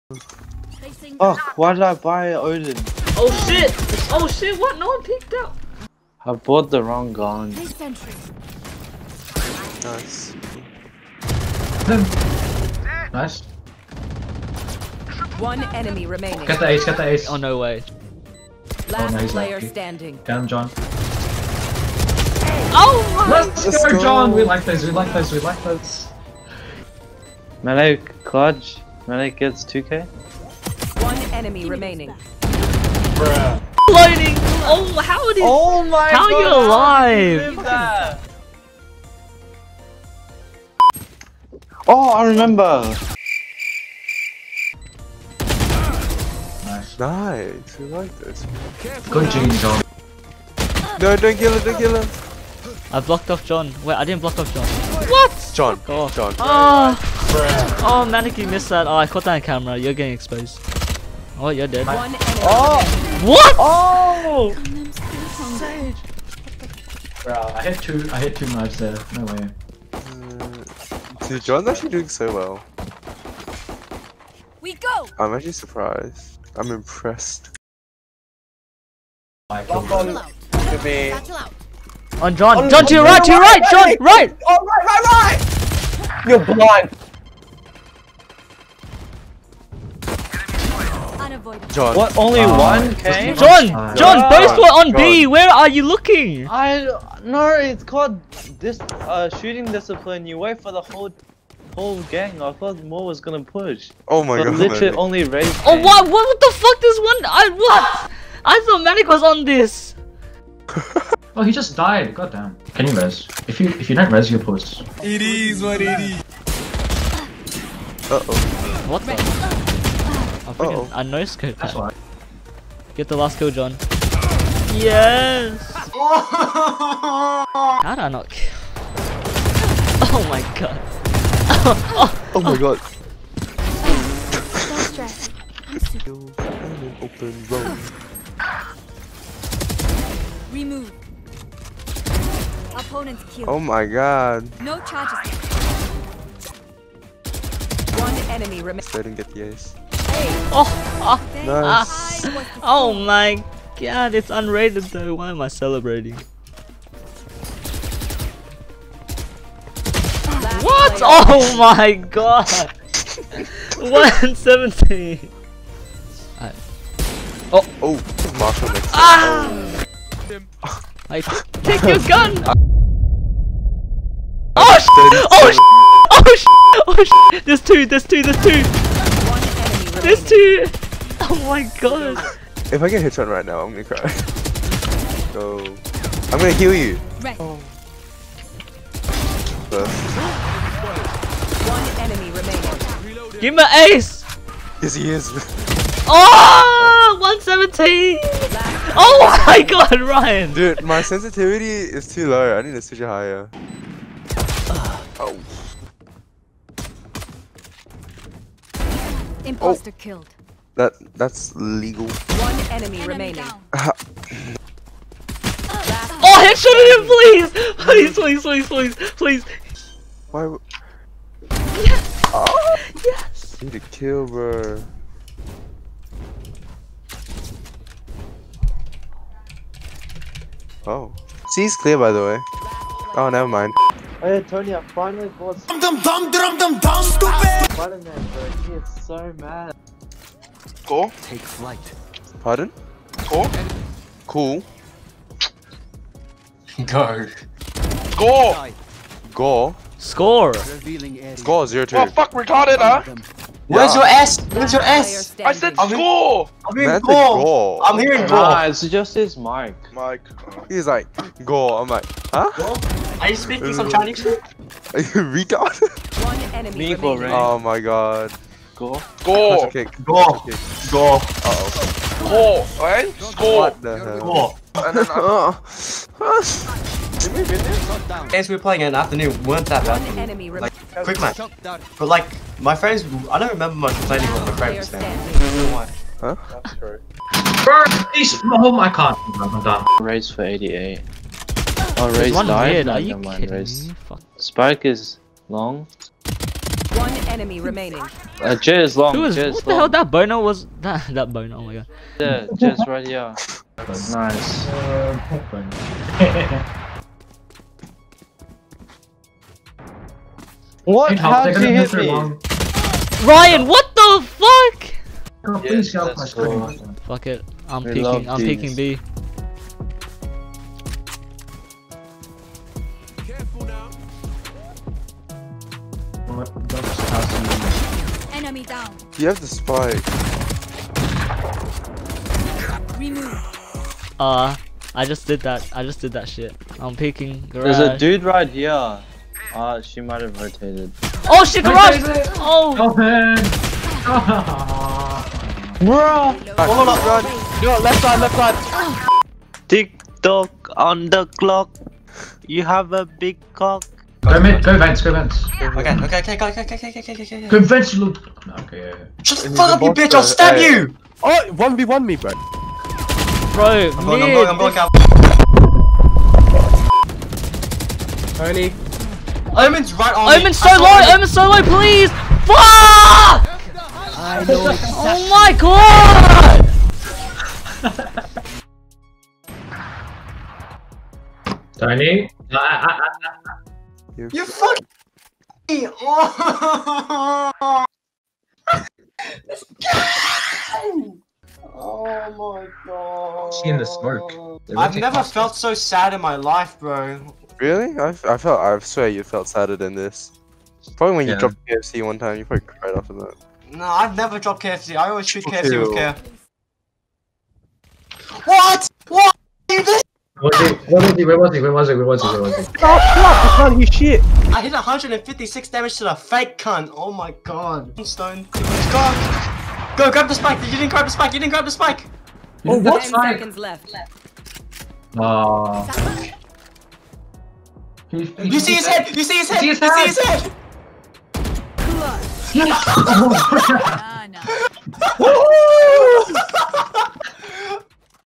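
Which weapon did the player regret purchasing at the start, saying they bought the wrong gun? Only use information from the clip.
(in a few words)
Odin.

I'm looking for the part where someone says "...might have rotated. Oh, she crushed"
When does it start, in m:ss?
5:39.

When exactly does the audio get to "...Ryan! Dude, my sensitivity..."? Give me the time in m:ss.
3:20.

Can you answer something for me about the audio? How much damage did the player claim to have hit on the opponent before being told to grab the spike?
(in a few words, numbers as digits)
156.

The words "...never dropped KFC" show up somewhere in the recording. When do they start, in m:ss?
6:44.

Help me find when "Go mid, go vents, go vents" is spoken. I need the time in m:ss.
5:54.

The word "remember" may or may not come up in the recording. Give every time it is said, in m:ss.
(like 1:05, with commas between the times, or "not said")
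0:42, 4:43.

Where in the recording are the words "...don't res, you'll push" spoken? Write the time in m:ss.
1:53.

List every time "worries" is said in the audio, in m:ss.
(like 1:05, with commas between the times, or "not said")
not said.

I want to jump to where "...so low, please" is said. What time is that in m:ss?
6:11.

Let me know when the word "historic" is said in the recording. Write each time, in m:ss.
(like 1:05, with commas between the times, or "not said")
not said.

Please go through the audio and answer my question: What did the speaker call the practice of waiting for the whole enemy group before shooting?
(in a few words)
shooting discipline.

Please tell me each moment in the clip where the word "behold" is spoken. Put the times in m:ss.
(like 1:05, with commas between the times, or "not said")
not said.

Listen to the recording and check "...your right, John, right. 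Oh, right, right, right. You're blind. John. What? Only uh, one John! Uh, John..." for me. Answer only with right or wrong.
right.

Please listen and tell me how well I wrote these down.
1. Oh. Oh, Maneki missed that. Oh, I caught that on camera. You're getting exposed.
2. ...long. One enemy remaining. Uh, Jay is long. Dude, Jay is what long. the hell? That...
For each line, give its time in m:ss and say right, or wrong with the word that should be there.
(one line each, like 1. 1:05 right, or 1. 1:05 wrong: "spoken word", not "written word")
1. 0:56 right
2. 4:55 right.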